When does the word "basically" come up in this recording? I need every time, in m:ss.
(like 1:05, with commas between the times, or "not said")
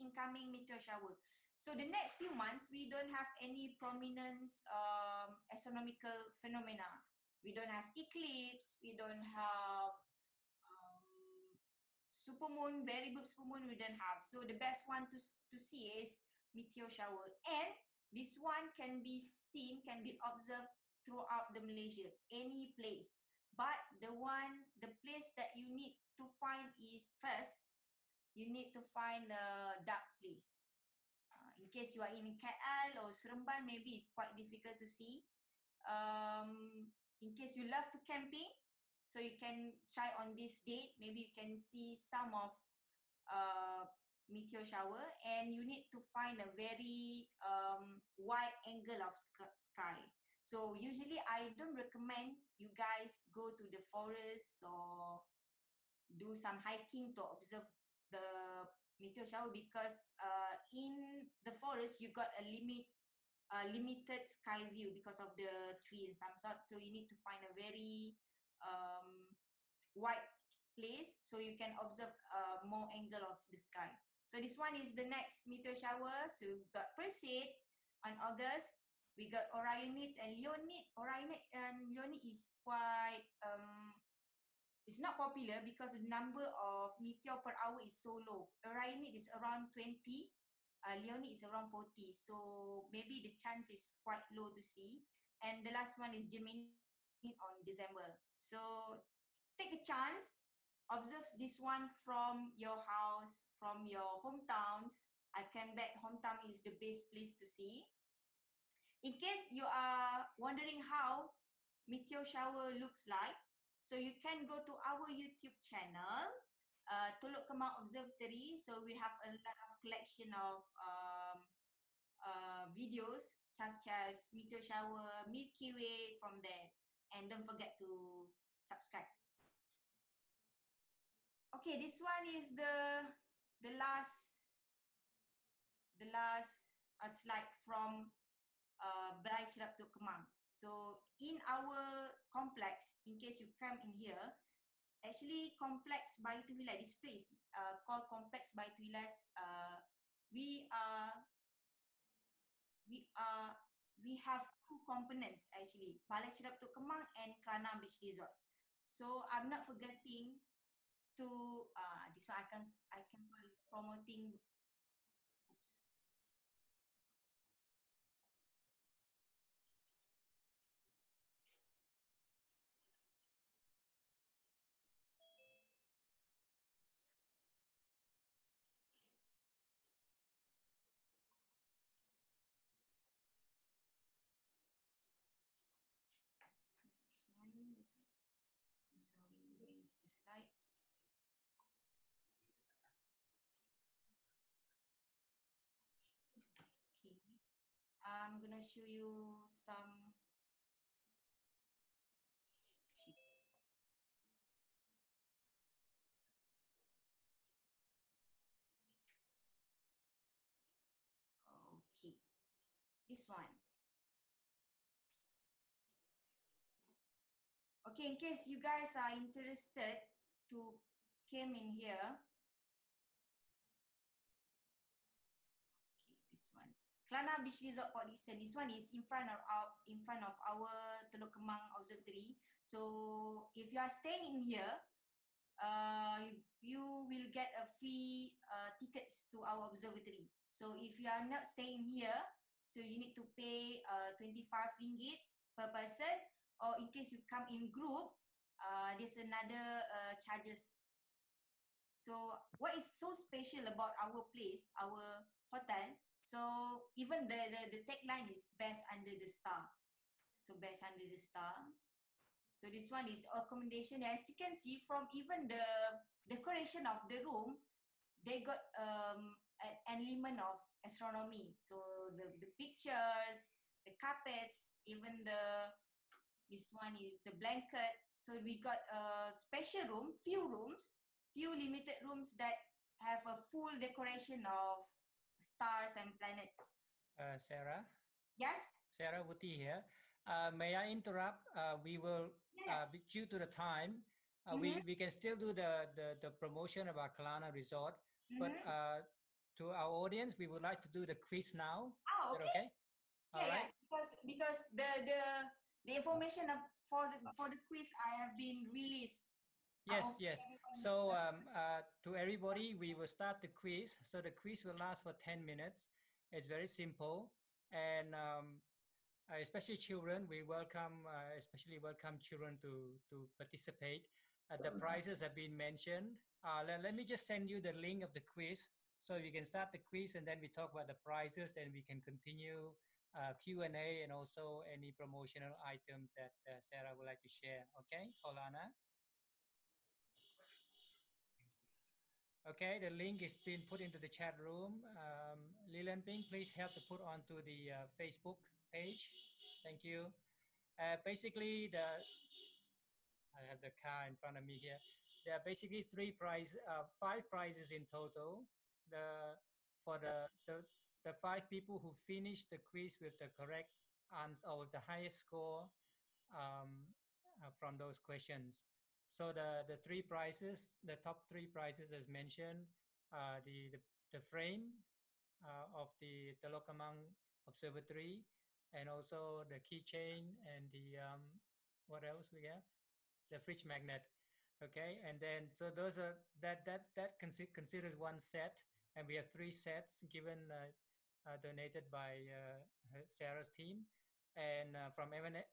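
5:51, 5:55.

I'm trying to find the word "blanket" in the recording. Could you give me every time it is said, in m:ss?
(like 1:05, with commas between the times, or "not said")
4:37.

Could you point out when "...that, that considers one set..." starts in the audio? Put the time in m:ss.
6:26.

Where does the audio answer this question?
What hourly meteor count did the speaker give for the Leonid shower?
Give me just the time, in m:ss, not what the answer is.
1:31.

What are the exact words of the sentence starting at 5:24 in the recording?
Uh, the prizes have been mentioned.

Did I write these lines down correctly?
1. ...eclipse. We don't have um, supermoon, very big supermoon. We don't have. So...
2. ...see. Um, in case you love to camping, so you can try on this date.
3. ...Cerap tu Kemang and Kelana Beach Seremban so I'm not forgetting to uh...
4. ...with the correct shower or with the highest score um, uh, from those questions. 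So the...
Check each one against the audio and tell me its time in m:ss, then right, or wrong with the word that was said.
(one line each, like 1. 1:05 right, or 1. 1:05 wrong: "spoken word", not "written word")
1. 0:07 right
2. 0:34 right
3. 2:36 wrong: "Resort", not "Seremban"
4. 6:02 wrong: "answer", not "shower".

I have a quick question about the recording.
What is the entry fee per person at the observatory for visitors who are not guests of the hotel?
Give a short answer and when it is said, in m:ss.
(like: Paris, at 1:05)
25 ringgit, at 4:04.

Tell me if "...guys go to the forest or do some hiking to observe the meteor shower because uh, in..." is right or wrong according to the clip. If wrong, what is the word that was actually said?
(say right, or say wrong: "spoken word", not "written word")
right.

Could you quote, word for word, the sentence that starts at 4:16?
So even the, the, the tagline is best under the star.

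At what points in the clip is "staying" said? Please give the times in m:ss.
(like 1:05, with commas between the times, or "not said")
3:53, 4:01.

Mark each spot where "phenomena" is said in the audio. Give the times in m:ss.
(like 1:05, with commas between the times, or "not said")
0:06.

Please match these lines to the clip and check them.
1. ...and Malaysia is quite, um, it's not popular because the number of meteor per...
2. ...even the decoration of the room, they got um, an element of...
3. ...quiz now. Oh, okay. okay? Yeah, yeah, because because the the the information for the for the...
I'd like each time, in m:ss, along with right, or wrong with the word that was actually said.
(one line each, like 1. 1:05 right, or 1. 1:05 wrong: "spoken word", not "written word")
1. 1:21 wrong: "Leonid", not "Malaysia"
2. 4:25 right
3. 5:01 right.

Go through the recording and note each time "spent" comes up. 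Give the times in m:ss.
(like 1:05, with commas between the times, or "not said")
not said.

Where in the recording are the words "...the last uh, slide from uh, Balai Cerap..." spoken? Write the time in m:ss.
2:15.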